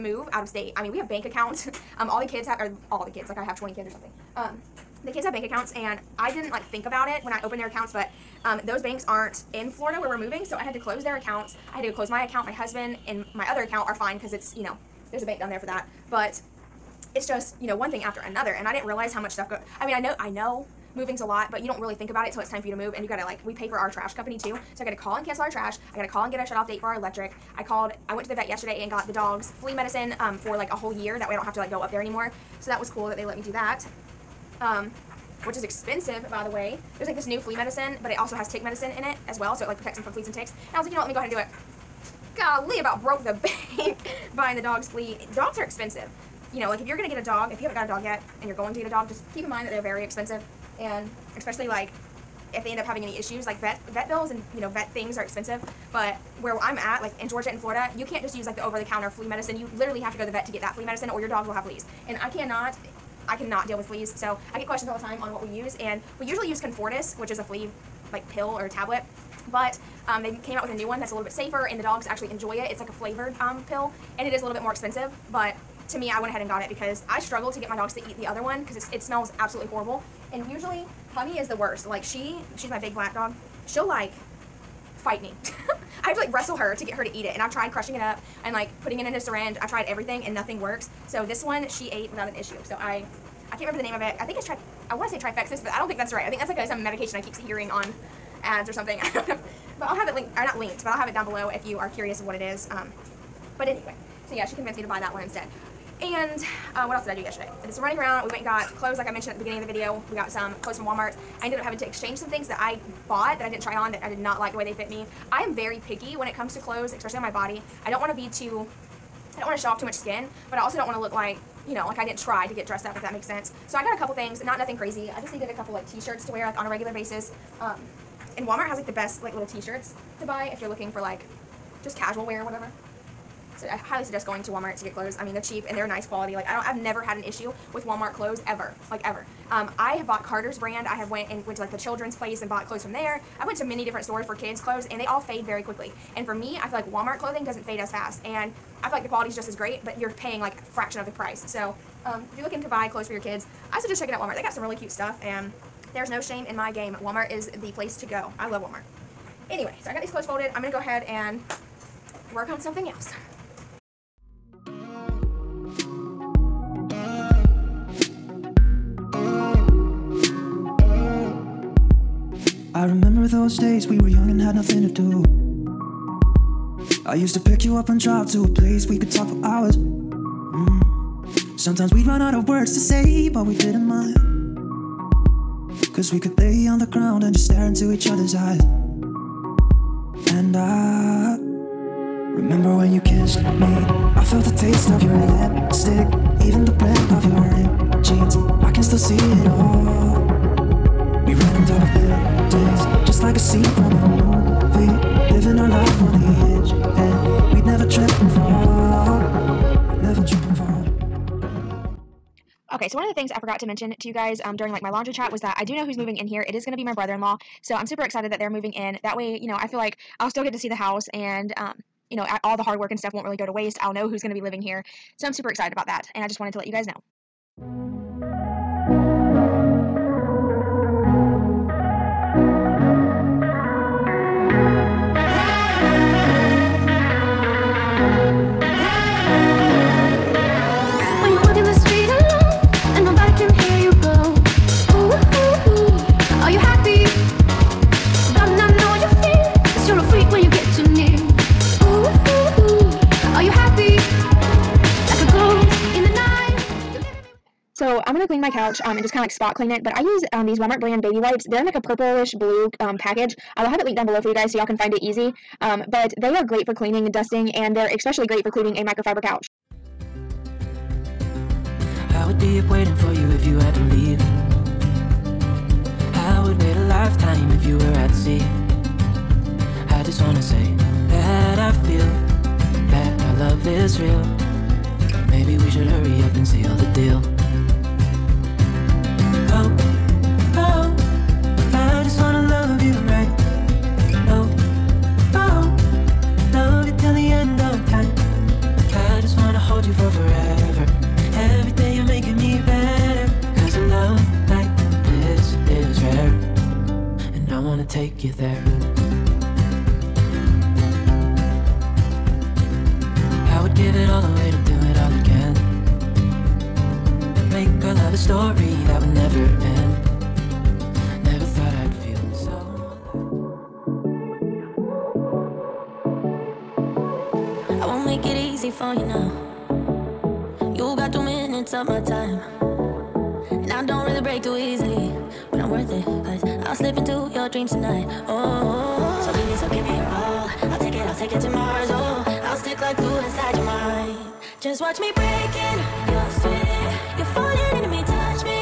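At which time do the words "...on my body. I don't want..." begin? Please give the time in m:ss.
1:57.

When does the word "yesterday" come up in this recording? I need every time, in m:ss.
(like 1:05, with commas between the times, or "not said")
0:28, 1:47.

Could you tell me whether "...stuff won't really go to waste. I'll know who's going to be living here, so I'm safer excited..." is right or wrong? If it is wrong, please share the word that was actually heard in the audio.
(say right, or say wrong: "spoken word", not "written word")
wrong: "super", not "safer".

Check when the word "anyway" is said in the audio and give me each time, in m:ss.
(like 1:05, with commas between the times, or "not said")
1:43, 2:39.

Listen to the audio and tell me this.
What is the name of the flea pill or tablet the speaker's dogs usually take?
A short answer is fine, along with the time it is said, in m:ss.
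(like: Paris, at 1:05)
Comfortis, at 1:06.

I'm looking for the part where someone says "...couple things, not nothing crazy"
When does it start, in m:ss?
2:03.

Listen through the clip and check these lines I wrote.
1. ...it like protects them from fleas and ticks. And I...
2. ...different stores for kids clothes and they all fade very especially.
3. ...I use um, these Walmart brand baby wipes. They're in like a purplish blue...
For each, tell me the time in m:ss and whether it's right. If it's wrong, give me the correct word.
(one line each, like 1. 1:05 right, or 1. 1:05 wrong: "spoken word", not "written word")
1. 0:39 right
2. 2:23 wrong: "quickly", not "especially"
3. 4:19 right.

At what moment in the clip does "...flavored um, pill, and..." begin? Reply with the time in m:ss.
1:12.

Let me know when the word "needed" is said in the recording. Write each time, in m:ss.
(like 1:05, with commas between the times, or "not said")
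2:05.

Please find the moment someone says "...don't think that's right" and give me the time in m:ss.
1:35.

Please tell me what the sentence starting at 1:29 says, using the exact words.
I've tried everything and nothing works.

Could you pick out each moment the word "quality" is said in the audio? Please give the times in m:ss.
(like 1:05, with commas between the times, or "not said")
2:16, 2:29.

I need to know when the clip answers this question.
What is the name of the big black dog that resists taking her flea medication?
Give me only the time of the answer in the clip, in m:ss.
1:21.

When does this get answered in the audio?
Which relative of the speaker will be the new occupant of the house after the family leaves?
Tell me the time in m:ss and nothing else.
3:36.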